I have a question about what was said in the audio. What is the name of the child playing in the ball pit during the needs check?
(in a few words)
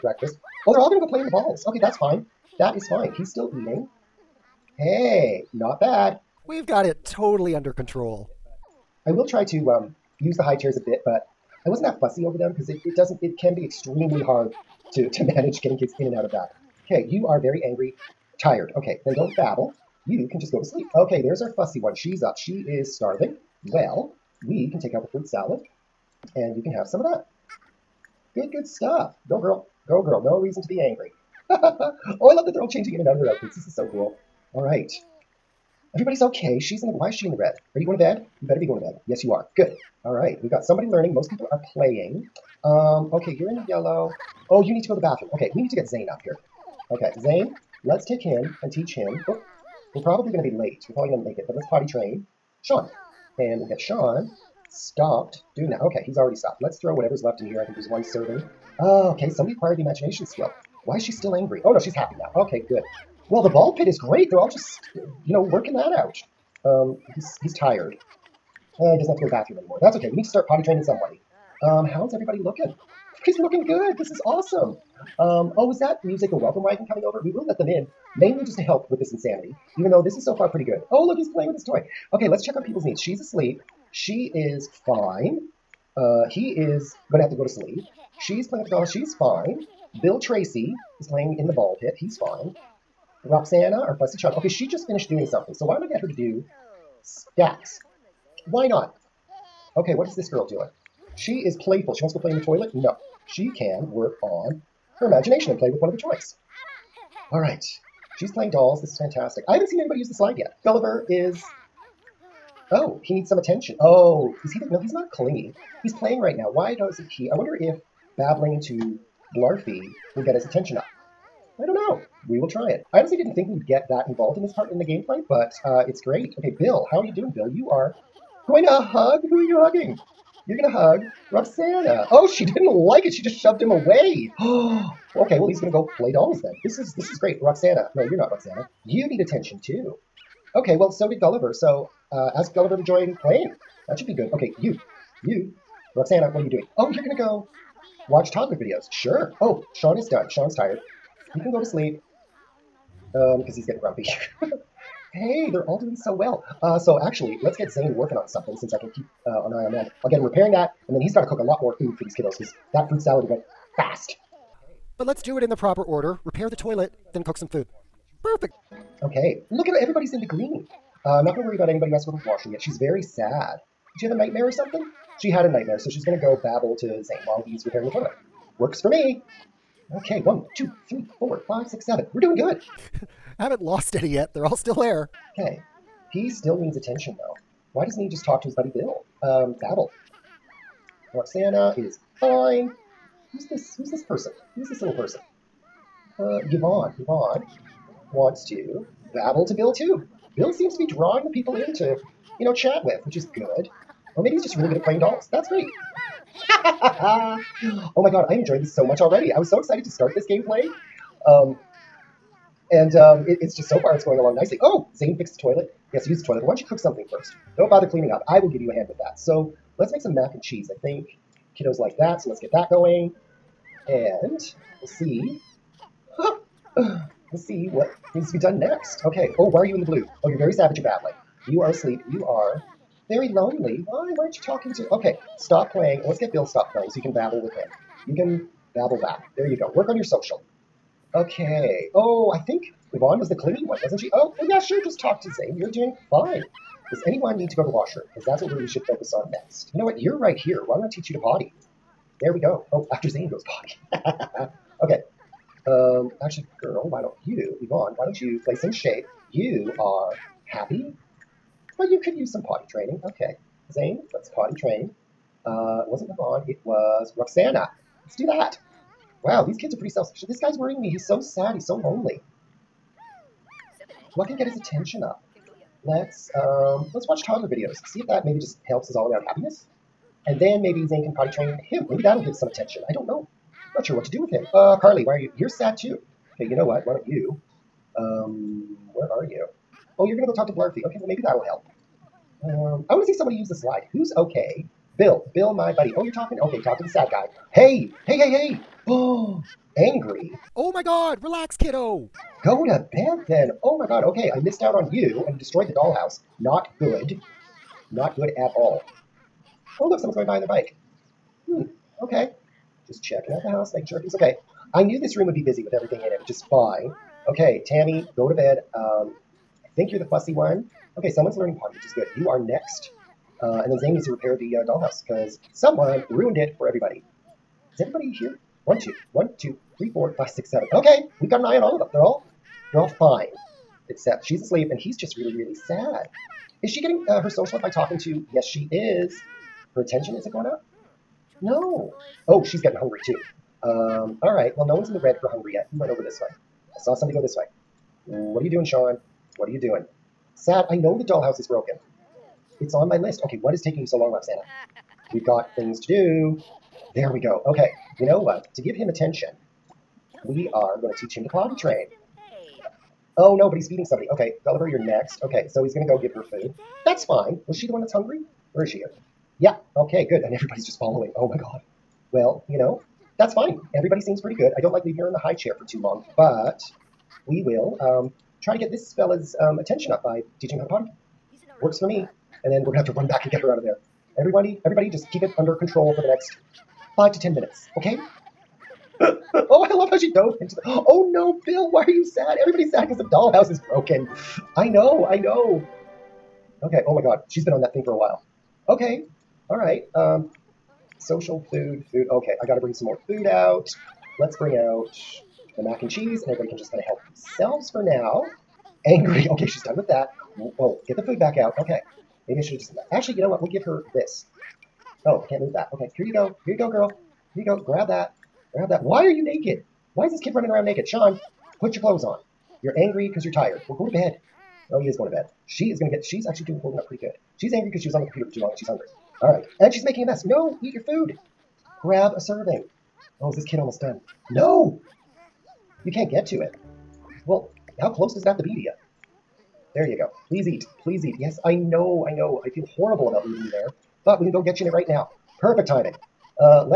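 Bill Tracy.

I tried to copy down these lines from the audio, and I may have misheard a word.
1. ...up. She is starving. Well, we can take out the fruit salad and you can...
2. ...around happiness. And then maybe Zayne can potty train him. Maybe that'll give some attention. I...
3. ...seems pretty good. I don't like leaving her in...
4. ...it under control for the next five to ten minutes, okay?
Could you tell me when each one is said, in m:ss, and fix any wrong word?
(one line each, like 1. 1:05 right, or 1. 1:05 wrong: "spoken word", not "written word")
1. 0:22 right
2. 4:39 right
3. 6:14 right
4. 6:25 right.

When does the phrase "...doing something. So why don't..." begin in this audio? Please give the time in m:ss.
1:35.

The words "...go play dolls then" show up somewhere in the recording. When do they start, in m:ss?
2:15.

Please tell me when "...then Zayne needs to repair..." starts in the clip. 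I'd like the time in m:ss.
5:23.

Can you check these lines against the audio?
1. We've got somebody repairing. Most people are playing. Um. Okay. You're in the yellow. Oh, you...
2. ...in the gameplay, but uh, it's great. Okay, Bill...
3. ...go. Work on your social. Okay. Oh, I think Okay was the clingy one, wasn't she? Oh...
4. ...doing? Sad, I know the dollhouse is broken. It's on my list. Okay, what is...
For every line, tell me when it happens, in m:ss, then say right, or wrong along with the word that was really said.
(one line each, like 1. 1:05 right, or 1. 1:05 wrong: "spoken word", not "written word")
1. 0:40 wrong: "learning", not "repairing"
2. 2:04 right
3. 3:59 wrong: "Yvonne", not "Okay"
4. 5:49 right.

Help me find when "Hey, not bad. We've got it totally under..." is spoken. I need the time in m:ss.
0:04.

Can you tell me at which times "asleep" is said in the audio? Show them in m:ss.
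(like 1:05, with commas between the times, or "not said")
1:23, 3:51, 5:34.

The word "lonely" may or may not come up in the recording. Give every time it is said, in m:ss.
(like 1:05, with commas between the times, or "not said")
3:53, 4:31.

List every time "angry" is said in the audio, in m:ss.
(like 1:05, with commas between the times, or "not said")
0:17, 0:30, 1:01, 4:59, 6:48, 7:02, 7:07.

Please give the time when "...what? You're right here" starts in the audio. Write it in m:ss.
4:09.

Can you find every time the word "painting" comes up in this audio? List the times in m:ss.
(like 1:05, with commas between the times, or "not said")
not said.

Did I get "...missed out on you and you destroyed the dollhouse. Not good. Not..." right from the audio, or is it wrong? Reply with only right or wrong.
right.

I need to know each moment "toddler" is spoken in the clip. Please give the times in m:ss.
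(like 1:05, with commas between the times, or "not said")
2:28, 4:37.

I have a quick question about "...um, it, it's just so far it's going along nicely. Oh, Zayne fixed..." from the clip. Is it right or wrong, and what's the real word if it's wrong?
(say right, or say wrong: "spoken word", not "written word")
right.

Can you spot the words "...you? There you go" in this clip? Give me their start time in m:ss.
7:18.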